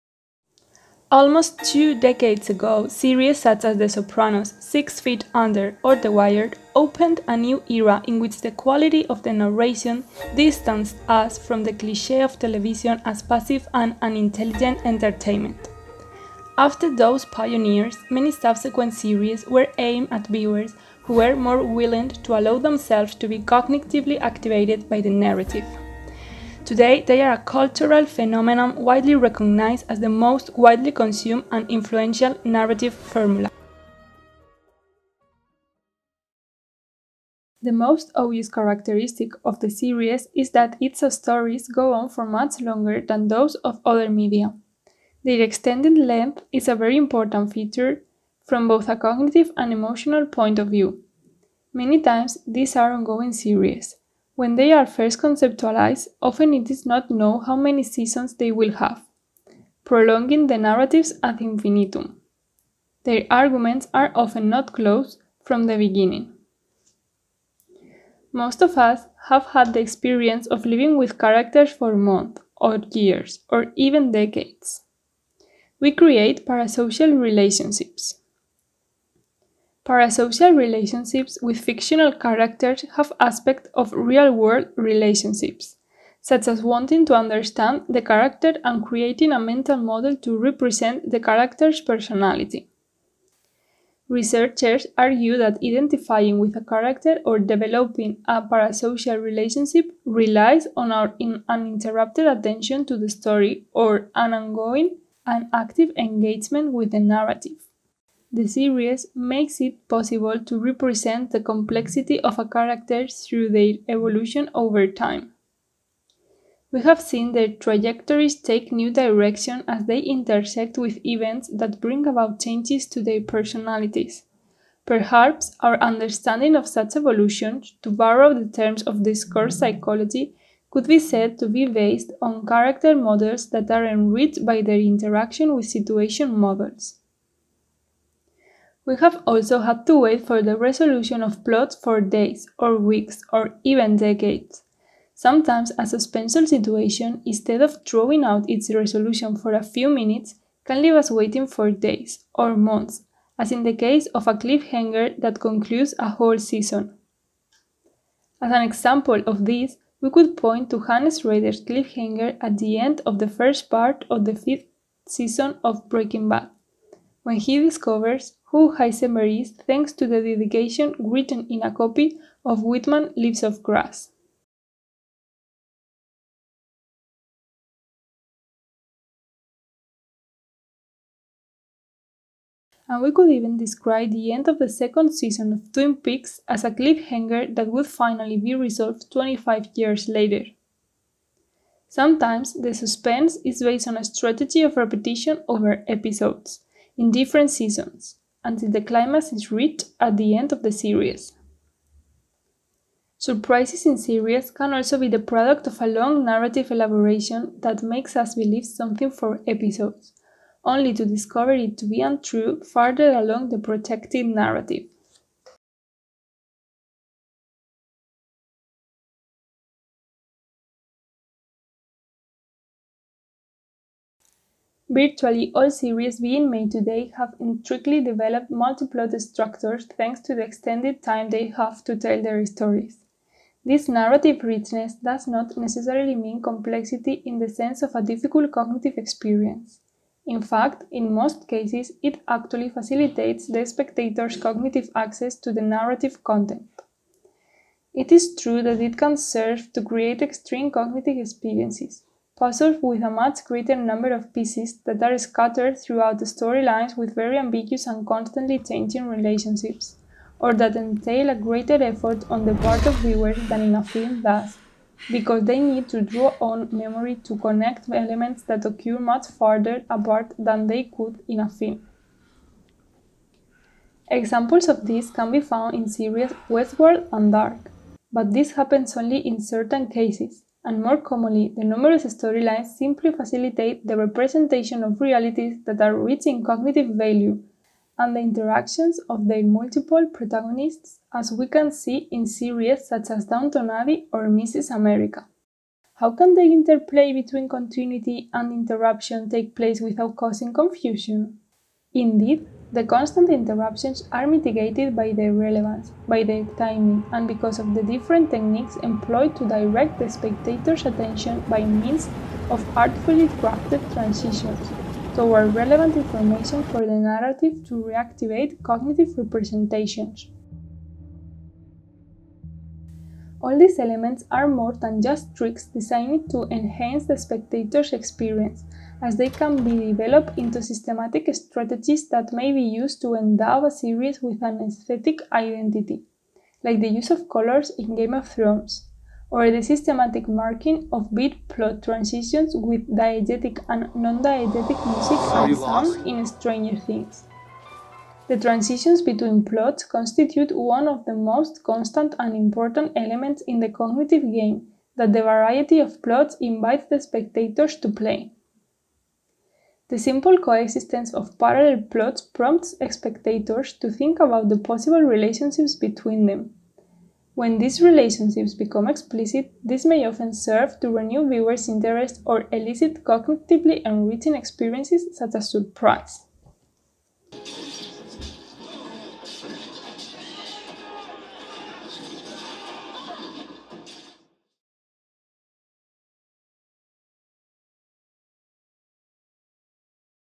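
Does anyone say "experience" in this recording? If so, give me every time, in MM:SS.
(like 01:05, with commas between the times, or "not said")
01:09, 03:58, 04:11, 05:27, 06:14.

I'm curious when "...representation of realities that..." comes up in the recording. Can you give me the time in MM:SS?
04:43.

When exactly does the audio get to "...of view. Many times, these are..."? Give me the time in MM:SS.
00:50.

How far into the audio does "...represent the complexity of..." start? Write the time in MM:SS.
01:50.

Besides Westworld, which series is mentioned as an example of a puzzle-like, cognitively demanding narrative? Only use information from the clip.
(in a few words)
Dark.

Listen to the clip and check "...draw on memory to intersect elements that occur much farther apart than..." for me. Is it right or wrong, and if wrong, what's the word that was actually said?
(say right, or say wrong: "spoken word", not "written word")
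wrong: "connect", not "intersect".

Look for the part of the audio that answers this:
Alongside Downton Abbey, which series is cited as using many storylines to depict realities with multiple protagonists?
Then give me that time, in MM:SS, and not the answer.
04:54.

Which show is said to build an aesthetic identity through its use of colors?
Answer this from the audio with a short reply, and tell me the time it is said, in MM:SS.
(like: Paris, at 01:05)
Game of Thrones, at 05:37.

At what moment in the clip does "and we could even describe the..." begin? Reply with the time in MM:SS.
03:02.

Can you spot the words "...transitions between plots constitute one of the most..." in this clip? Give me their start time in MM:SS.
05:48.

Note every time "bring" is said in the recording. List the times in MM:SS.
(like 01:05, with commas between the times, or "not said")
02:01.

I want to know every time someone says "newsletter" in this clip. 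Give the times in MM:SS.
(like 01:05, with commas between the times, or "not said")
not said.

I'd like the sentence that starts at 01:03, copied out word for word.
Their arguments are often not closed from the beginning.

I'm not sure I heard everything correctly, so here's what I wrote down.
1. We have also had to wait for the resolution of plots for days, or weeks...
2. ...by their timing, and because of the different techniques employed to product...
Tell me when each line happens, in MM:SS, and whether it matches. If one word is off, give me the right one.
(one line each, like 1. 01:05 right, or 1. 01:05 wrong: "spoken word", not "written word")
1. 02:18 right
2. 05:06 wrong: "direct", not "product".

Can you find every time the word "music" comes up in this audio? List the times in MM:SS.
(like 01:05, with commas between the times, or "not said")
05:44.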